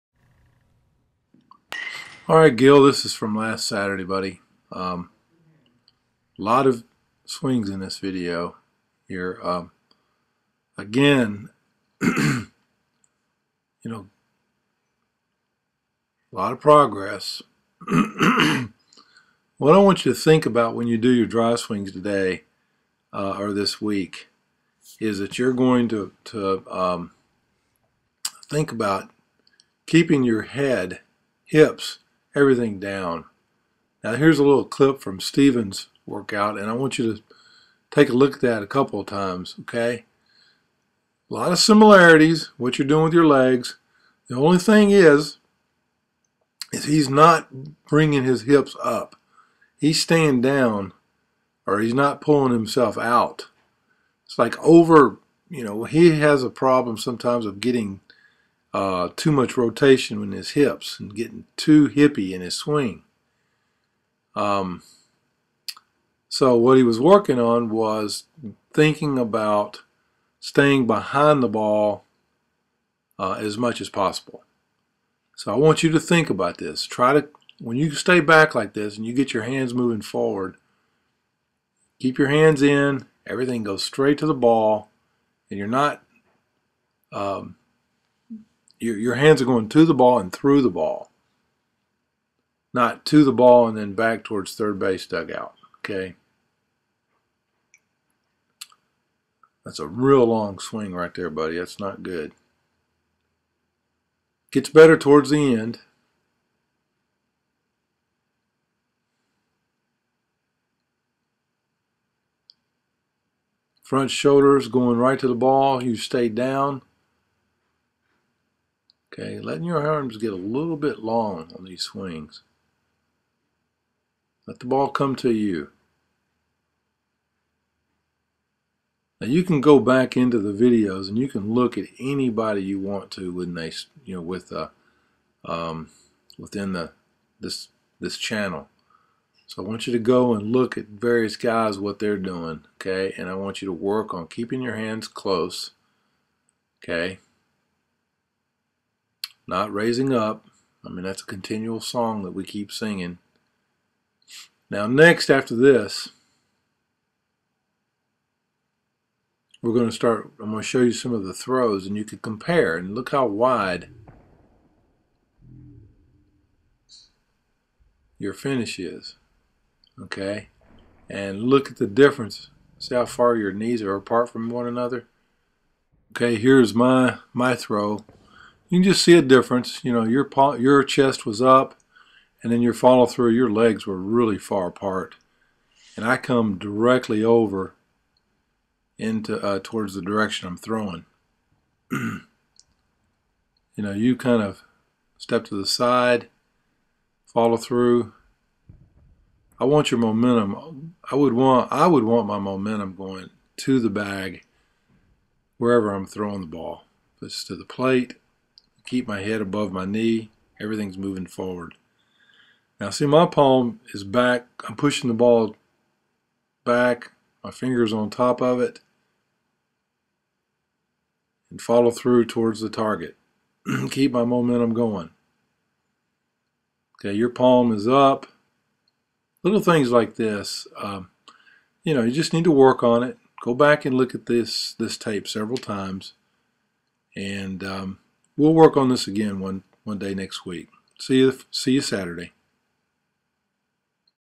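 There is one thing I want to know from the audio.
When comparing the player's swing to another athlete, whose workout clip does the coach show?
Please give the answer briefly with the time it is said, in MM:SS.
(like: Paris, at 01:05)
Stephen, at 00:35.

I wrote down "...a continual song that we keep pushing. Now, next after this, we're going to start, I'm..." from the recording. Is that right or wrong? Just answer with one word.
wrong.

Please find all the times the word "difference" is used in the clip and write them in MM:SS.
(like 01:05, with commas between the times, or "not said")
02:51, 02:59.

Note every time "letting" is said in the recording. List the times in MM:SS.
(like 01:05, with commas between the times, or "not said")
01:59.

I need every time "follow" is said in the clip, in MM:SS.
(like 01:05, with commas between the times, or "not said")
03:02, 03:17, 03:41.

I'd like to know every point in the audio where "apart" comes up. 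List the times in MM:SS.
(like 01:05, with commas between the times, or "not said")
02:53, 03:04.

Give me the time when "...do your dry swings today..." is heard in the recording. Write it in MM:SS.
00:20.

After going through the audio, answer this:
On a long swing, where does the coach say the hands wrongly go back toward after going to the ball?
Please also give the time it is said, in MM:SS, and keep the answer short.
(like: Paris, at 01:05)
third base dugout, at 01:34.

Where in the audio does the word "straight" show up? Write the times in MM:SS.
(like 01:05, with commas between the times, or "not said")
01:23.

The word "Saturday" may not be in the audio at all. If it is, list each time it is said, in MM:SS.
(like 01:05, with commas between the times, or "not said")
00:03, 04:01.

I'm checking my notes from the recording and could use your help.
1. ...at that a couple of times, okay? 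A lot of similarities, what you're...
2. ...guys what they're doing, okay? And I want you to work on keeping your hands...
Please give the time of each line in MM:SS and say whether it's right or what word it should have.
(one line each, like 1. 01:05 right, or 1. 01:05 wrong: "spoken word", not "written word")
1. 00:38 right
2. 02:21 right.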